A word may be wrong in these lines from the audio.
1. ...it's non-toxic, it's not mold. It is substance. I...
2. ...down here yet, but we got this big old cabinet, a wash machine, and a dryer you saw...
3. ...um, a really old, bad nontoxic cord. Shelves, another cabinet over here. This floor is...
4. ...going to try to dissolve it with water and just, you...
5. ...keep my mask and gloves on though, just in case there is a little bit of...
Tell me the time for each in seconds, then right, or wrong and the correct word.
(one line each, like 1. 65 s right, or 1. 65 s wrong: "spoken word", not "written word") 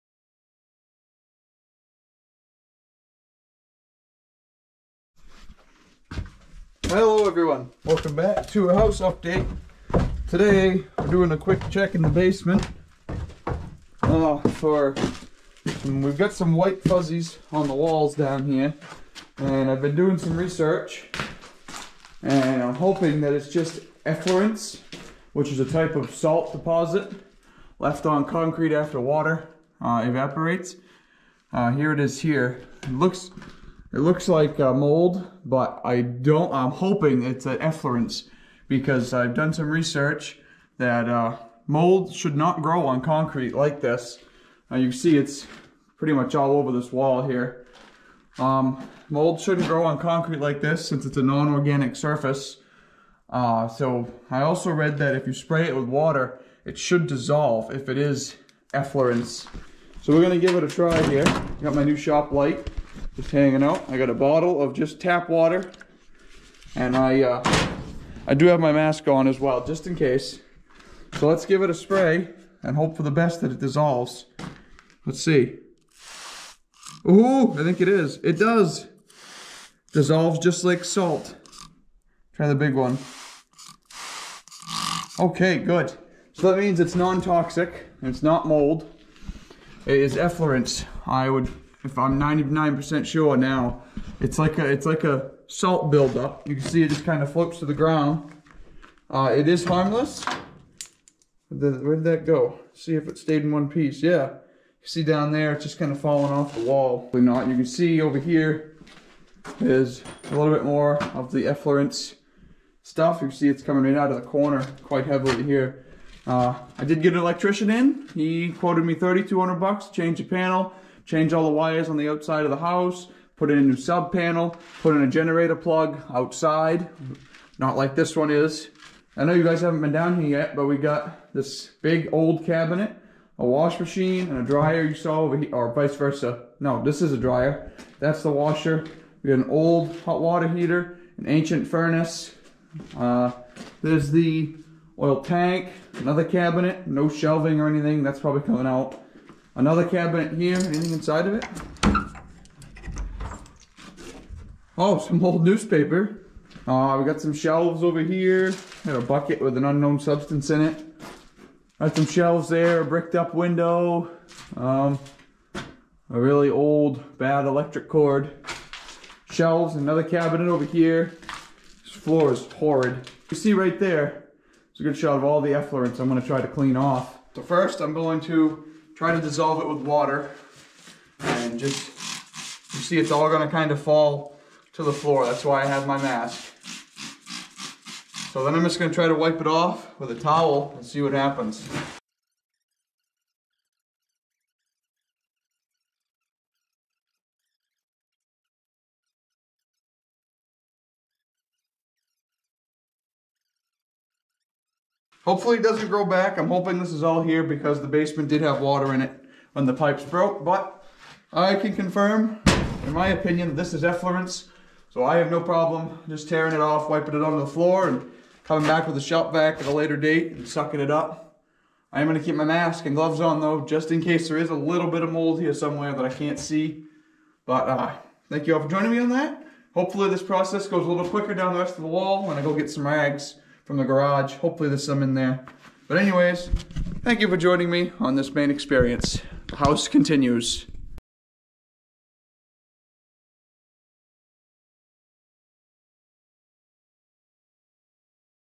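1. 86 s wrong: "effluence", not "substance"
2. 129 s right
3. 164 s wrong: "electric", not "nontoxic"
4. 177 s right
5. 222 s right.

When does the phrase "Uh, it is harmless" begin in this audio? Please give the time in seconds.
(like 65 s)
99 s.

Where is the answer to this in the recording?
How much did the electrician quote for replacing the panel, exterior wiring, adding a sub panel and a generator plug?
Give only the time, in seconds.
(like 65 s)
118 s.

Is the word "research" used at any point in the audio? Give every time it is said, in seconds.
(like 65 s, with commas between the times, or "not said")
20 s, 39 s.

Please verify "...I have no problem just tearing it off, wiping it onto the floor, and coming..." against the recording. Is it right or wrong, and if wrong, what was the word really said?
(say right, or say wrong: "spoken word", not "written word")
right.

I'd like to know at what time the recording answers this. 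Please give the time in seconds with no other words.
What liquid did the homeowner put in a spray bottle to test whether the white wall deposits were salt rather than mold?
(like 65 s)
64 s.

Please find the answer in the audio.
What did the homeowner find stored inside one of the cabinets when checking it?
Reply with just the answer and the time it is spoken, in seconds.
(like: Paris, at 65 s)
old newspaper, at 155 s.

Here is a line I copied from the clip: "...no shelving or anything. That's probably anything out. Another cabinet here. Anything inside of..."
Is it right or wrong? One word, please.
wrong.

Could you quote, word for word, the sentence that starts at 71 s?
So let's give it a spray and hope for the best that it dissolves.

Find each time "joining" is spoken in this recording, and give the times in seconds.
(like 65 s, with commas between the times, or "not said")
228 s, 237 s.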